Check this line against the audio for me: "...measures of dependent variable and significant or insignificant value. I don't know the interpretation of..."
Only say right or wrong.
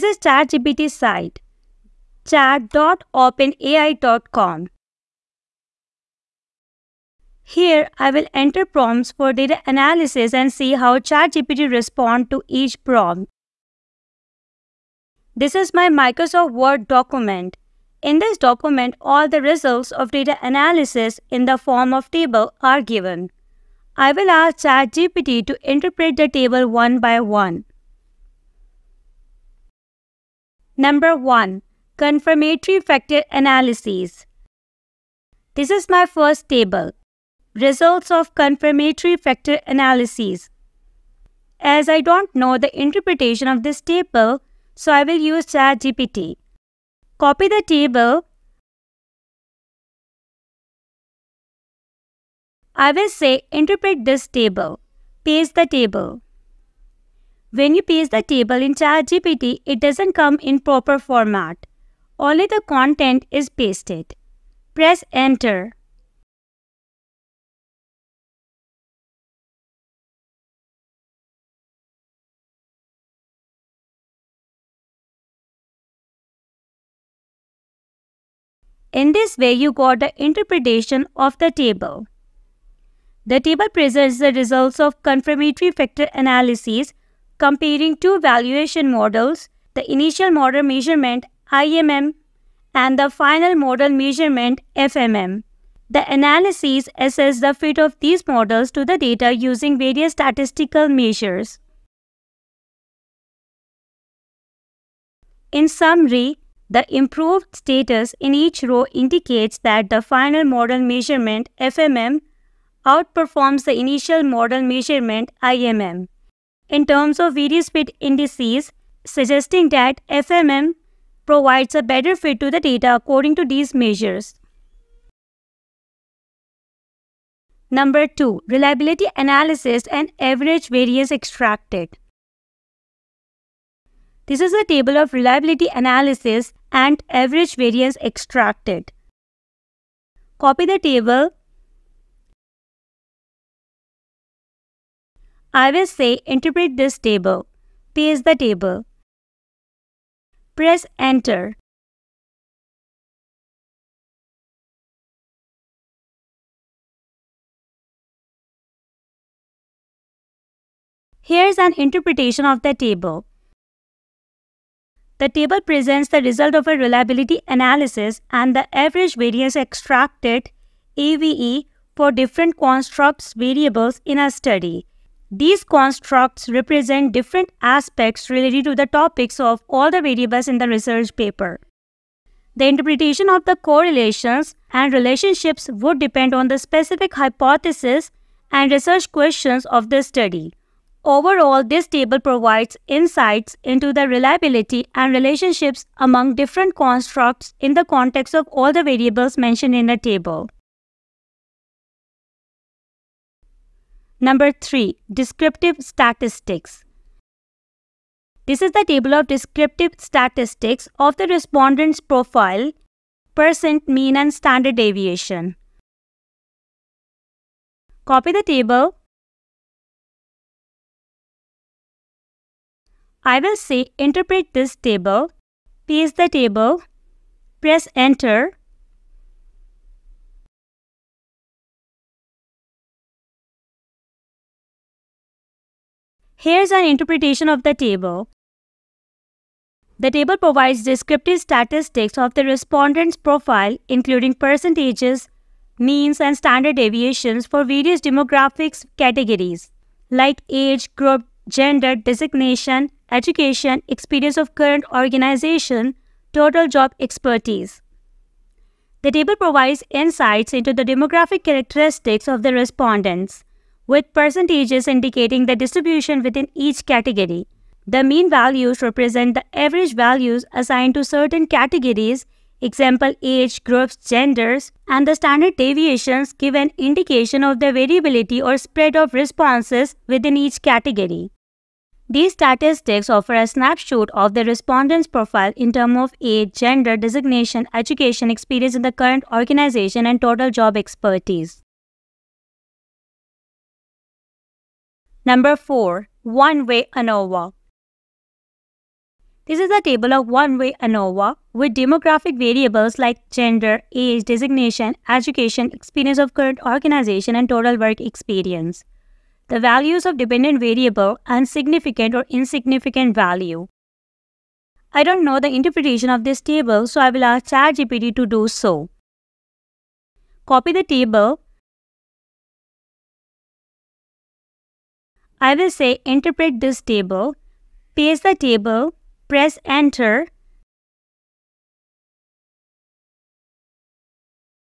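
wrong.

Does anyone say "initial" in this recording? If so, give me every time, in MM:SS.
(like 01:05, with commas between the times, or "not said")
01:29, 01:53.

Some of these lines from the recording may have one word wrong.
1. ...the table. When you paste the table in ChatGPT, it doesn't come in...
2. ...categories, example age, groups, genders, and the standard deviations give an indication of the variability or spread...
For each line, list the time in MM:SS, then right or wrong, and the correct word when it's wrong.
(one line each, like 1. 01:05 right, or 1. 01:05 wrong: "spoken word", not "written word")
1. 00:55 right
2. 04:31 right.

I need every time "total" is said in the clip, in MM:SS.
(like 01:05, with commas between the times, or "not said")
04:16, 04:50, 05:07.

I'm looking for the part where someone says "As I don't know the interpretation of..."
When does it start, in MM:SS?
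00:41.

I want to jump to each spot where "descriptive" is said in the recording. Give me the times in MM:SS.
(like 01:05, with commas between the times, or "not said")
03:25, 03:29, 04:00.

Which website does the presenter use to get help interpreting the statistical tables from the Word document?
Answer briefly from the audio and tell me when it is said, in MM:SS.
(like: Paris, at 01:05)
chat.openai.com, at 00:02.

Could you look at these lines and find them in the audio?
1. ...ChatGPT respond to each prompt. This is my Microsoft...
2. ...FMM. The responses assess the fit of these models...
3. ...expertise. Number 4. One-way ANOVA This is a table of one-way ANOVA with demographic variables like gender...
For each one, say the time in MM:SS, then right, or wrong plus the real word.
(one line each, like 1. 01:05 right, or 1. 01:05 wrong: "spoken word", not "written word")
1. 00:10 right
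2. 01:34 wrong: "analyses", not "responses"
3. 04:50 right.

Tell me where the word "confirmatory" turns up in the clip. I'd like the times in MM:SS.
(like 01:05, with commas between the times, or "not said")
00:31, 00:38, 01:25.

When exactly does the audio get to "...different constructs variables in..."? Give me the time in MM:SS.
02:52.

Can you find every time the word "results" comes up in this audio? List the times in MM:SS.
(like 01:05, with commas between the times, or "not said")
00:19, 00:37, 01:24, 02:46.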